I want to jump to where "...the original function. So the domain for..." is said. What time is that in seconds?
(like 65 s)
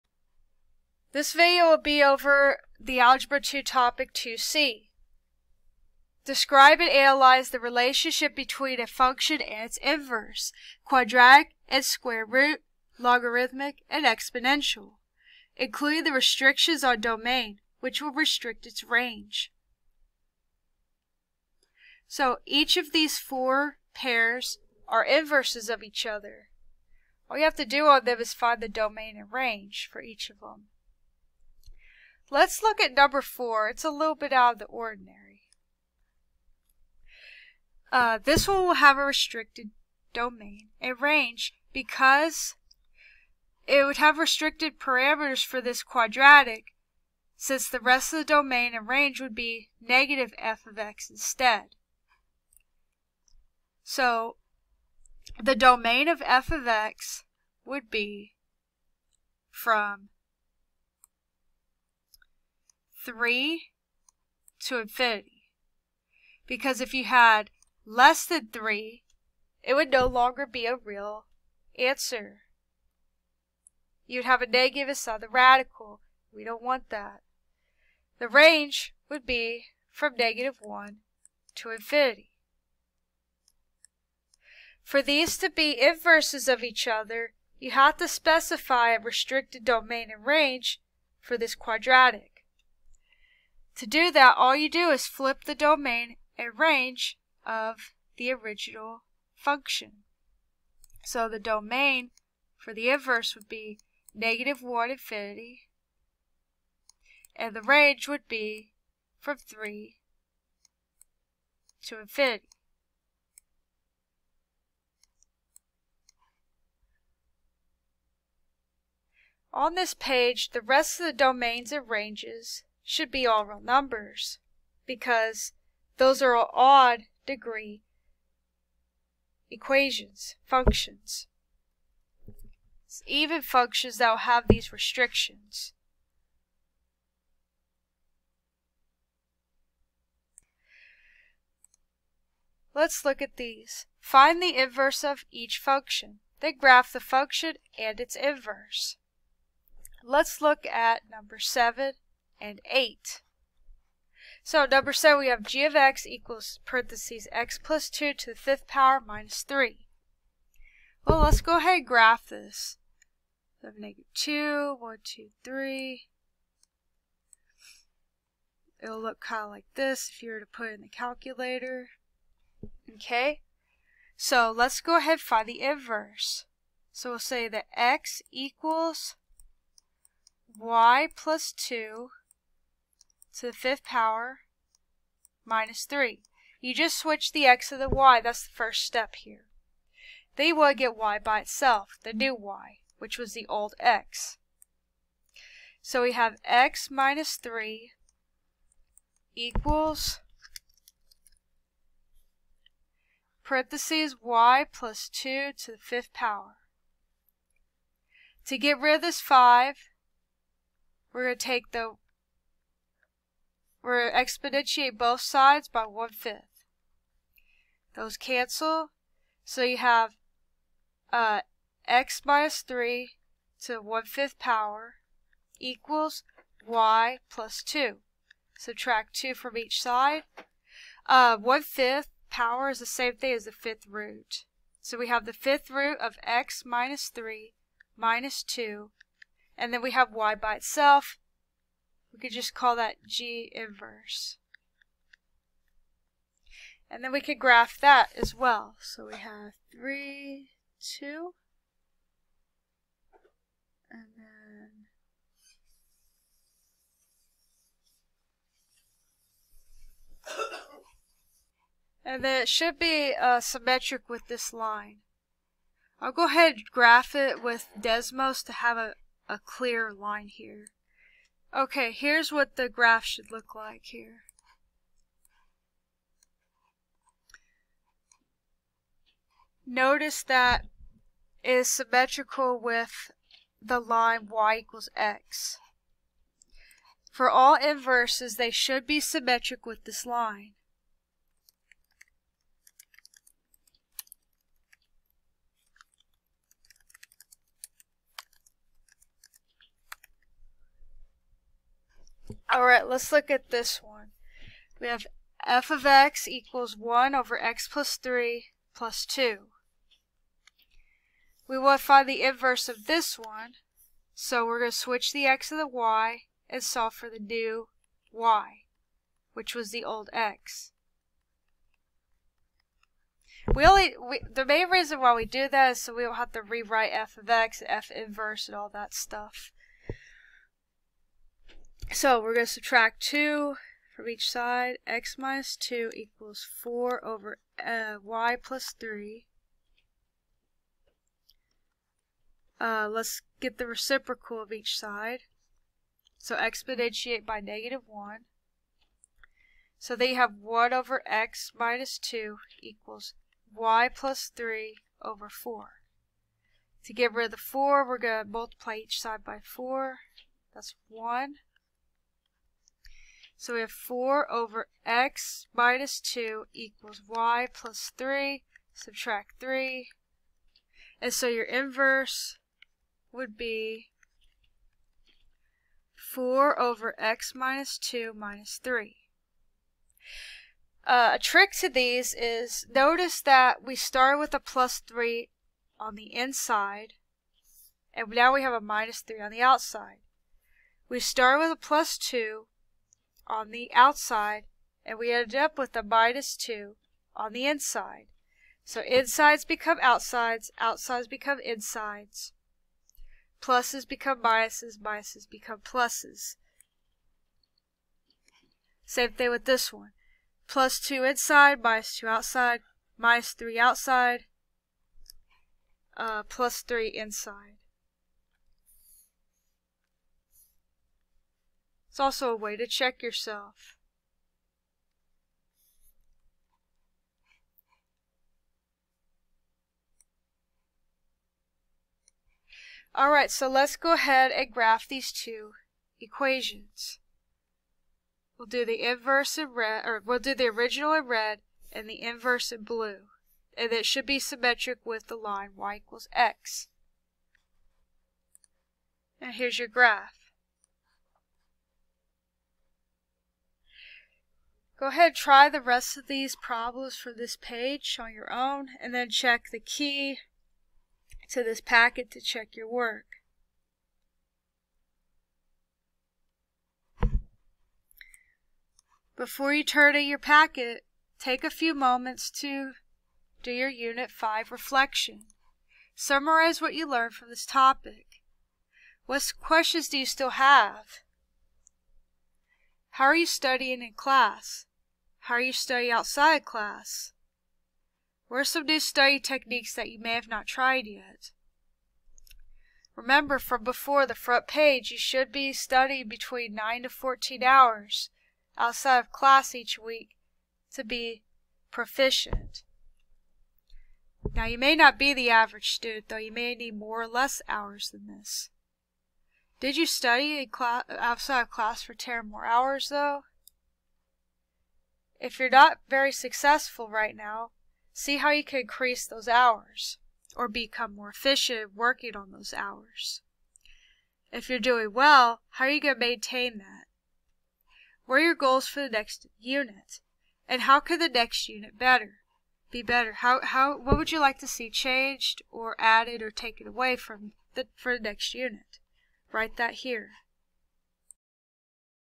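98 s.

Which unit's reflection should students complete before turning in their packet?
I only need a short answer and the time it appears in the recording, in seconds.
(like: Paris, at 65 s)
Unit 5, at 473 s.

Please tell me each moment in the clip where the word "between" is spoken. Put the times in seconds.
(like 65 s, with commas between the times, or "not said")
8 s, 496 s.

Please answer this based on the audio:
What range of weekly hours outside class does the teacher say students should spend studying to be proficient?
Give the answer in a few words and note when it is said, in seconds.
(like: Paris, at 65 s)
9 to 14, at 496 s.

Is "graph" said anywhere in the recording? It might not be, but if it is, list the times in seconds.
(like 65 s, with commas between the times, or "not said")
146 s, 161 s, 247 s, 266 s, 272 s, 434 s, 449 s.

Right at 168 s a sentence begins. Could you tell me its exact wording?
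It'll look kind of like this if you were to put it in the calculator.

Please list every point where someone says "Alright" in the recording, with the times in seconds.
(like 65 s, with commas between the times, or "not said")
432 s.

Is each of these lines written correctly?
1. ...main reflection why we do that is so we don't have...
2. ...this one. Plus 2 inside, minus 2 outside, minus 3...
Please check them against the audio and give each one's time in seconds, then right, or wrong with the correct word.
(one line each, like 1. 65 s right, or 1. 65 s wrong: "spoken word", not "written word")
1. 324 s wrong: "reason", not "reflection"
2. 409 s right.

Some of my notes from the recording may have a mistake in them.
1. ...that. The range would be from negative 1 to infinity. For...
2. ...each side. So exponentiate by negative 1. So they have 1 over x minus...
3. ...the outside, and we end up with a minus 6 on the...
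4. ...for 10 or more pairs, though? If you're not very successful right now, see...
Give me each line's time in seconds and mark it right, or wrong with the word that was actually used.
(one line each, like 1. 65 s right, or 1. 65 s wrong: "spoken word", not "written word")
1. 76 s right
2. 344 s right
3. 393 s wrong: "2", not "6"
4. 511 s wrong: "hours", not "pairs".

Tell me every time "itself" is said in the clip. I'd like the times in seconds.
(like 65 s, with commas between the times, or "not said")
191 s, 240 s.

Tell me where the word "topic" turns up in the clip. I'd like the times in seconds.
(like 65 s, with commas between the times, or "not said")
3 s, 477 s.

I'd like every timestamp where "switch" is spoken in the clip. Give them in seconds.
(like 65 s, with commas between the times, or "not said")
186 s, 314 s.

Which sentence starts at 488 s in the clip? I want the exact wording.
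What are some new study techniques that you may have not tried yet?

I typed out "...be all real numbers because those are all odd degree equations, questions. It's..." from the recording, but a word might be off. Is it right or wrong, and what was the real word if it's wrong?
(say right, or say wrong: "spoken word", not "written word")
wrong: "functions", not "questions".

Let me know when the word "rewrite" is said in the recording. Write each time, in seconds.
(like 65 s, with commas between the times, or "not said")
326 s.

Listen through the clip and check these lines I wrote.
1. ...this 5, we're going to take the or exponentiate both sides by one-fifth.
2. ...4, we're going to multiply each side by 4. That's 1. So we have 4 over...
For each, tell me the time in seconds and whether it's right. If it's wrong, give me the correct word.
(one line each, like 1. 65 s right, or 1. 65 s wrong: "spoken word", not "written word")
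1. 209 s right
2. 357 s right.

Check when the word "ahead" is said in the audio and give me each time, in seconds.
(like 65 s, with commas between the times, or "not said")
161 s, 174 s, 266 s, 433 s, 454 s.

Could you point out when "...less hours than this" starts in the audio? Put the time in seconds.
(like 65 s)
507 s.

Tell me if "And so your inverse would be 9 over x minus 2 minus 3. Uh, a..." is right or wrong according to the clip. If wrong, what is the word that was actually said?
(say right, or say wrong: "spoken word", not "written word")
wrong: "4", not "9".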